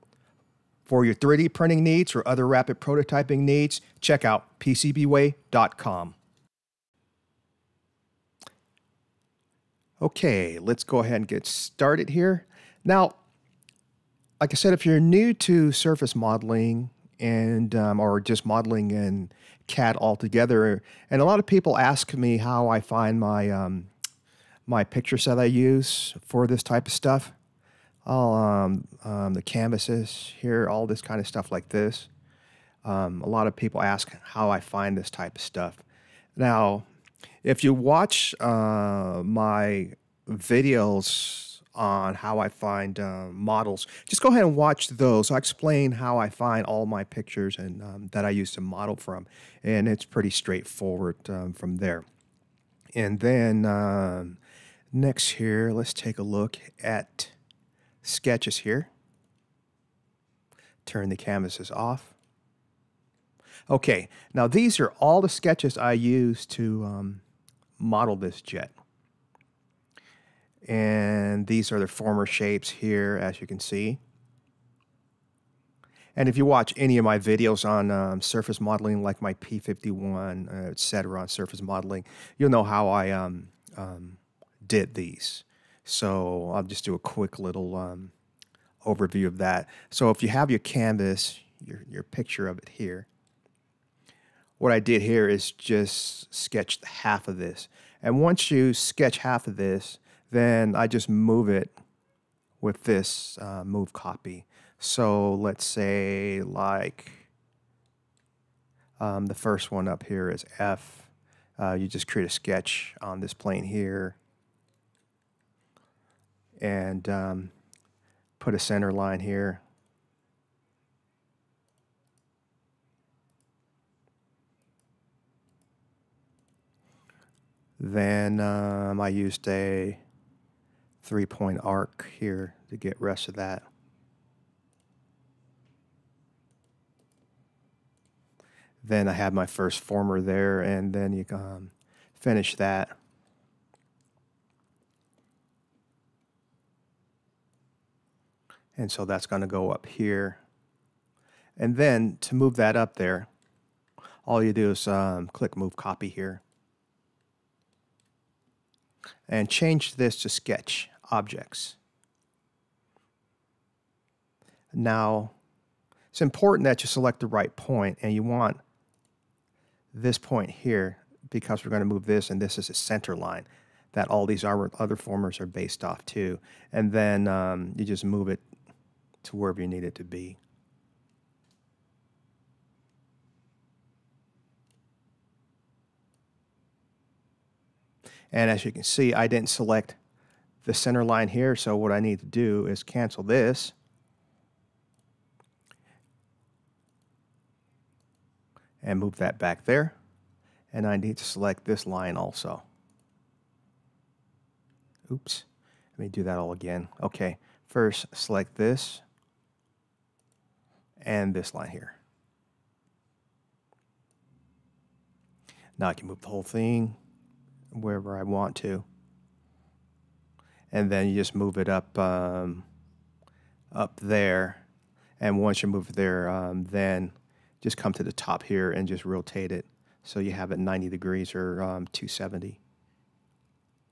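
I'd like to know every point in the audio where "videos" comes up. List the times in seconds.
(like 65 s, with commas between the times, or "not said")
40 s, 77 s.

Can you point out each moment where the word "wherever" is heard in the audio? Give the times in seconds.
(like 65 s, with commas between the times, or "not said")
179 s, 217 s.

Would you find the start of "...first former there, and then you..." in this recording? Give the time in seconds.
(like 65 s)
139 s.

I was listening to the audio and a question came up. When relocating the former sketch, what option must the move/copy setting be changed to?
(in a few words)
Sketch Objects.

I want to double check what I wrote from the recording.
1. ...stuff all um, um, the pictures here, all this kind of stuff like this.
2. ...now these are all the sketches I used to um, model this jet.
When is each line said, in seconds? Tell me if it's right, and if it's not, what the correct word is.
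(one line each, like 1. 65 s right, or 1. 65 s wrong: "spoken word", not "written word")
1. 26 s wrong: "canvases", not "pictures"
2. 64 s right.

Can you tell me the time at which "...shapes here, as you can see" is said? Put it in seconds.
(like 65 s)
72 s.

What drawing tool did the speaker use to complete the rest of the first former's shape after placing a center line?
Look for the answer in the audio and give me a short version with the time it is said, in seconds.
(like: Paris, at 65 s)
Three-point arc, at 131 s.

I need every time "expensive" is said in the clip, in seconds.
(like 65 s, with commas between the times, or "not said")
not said.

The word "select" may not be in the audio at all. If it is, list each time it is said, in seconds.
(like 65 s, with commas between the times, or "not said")
166 s, 189 s, 201 s, 208 s.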